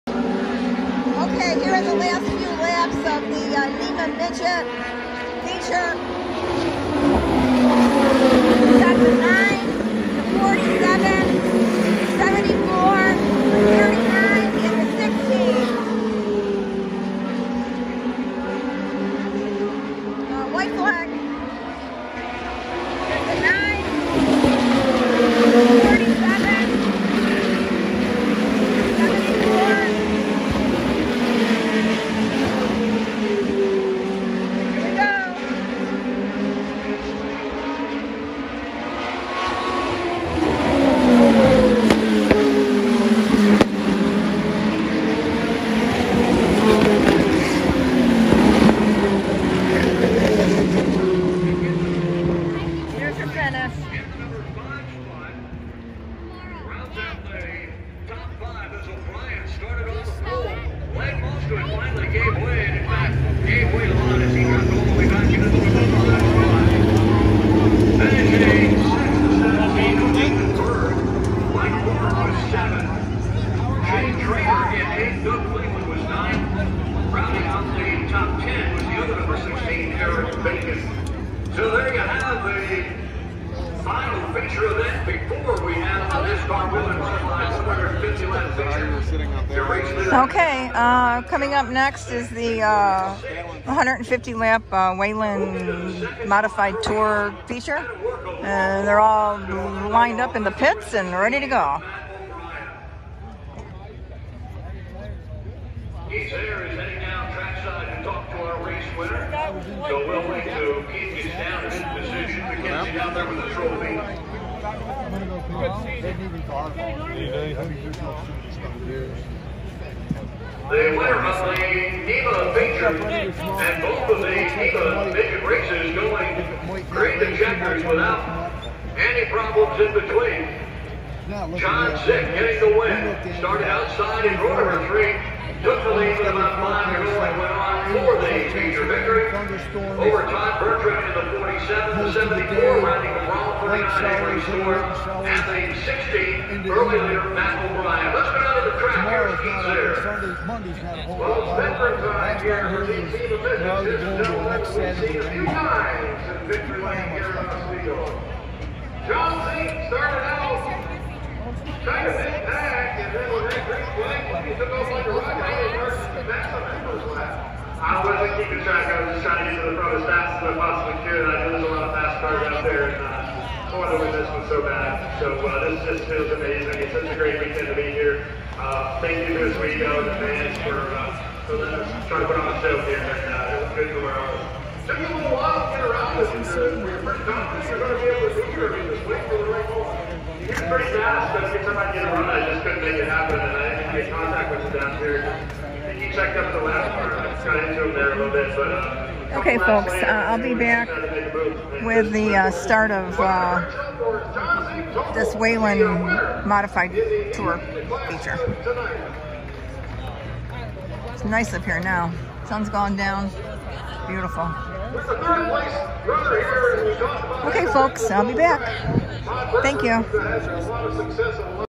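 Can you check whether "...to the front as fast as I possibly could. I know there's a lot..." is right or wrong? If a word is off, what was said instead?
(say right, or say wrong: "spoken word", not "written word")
right.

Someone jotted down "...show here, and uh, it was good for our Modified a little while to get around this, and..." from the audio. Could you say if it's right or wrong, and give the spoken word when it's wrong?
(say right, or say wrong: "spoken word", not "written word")
wrong: "Took", not "Modified".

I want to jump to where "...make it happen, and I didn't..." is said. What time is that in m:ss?
3:12.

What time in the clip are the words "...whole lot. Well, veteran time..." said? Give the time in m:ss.
2:31.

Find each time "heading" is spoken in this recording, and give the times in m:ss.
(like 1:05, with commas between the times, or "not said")
1:46.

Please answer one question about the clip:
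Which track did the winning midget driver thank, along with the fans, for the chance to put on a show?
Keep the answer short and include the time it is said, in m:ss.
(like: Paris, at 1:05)
Oswego, at 2:59.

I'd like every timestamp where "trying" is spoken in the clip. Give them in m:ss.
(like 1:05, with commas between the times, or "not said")
2:41, 2:49.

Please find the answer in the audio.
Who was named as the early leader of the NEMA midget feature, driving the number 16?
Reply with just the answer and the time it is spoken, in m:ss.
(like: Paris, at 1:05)
Matt O'Brien, at 2:27.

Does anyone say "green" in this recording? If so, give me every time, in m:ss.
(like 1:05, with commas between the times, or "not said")
2:06, 2:43.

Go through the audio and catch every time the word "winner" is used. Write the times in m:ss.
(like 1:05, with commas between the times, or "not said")
1:48, 2:00.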